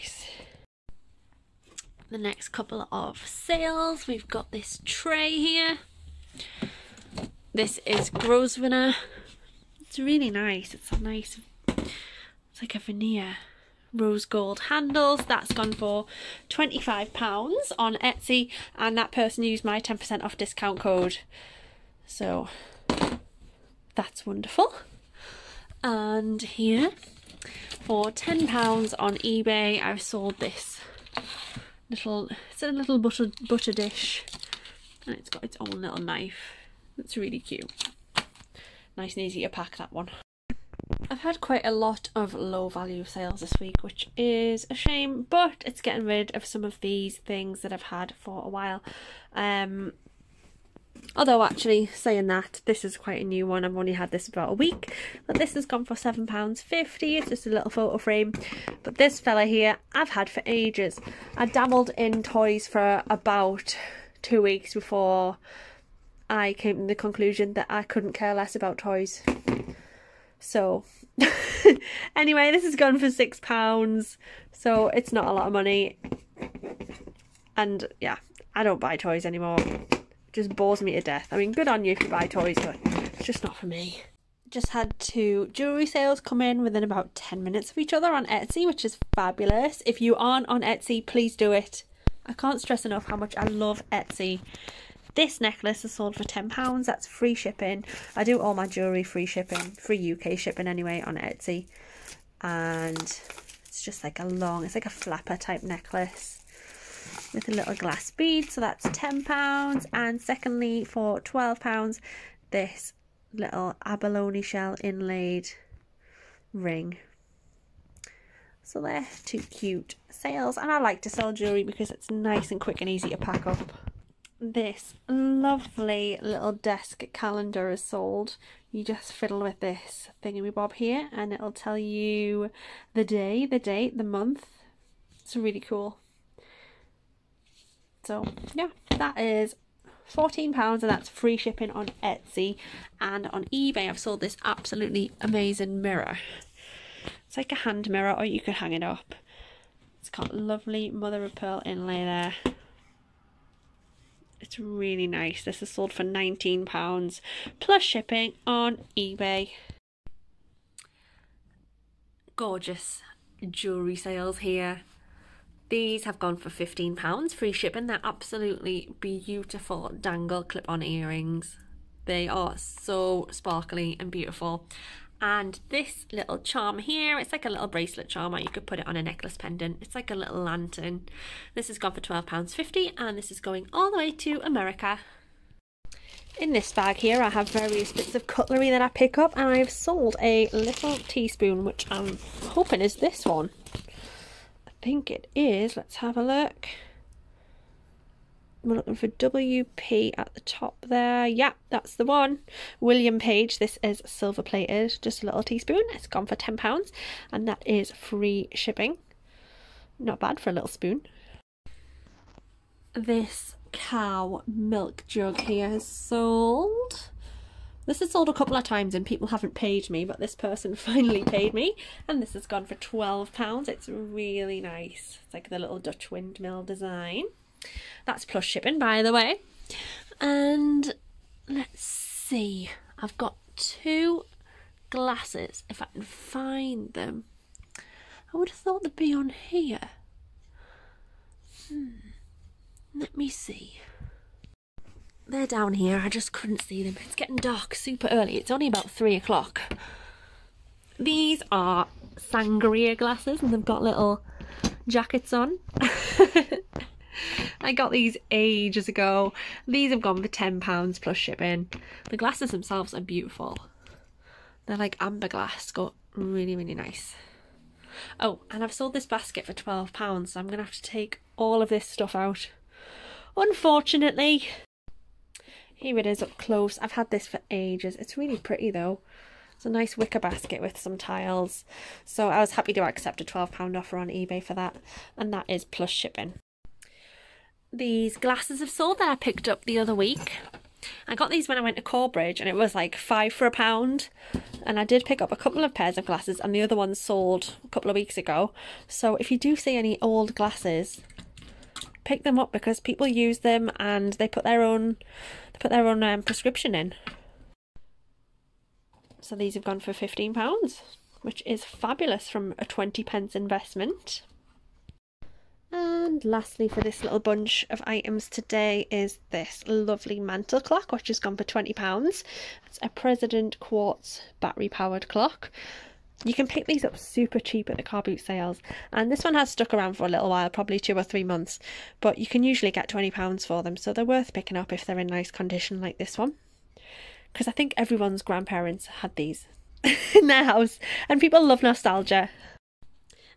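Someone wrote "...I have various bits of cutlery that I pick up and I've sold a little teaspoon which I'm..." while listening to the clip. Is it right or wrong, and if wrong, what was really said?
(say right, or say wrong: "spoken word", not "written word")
right.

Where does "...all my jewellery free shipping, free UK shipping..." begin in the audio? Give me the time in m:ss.
1:38.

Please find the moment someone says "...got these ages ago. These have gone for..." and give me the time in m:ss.
4:17.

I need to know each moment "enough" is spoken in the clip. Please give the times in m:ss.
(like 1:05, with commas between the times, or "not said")
1:32.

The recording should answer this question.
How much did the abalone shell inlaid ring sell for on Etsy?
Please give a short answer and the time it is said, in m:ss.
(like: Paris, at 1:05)
£12, at 1:51.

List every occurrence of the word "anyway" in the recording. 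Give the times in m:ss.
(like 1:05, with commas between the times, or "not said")
1:12, 1:40.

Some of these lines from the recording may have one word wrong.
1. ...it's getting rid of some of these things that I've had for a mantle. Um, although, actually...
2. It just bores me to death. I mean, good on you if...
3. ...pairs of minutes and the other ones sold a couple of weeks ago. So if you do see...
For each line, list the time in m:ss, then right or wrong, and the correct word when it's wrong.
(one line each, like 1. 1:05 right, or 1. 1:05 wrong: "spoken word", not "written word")
1. 0:45 wrong: "while", not "mantle"
2. 1:19 right
3. 4:55 wrong: "glasses", not "minutes".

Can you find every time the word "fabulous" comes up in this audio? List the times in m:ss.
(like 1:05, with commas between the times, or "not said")
1:29, 5:11.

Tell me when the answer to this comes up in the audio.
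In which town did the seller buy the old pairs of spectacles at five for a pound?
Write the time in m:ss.
4:51.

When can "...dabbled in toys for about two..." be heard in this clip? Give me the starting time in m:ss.
1:01.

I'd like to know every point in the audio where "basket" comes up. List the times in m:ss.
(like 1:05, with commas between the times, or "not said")
4:29, 4:40.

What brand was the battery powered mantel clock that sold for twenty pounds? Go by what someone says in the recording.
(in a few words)
President Quartz.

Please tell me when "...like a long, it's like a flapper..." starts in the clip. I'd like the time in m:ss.
1:44.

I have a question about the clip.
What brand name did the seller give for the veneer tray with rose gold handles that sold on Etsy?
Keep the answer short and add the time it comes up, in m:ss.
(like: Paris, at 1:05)
Grosvenor, at 0:08.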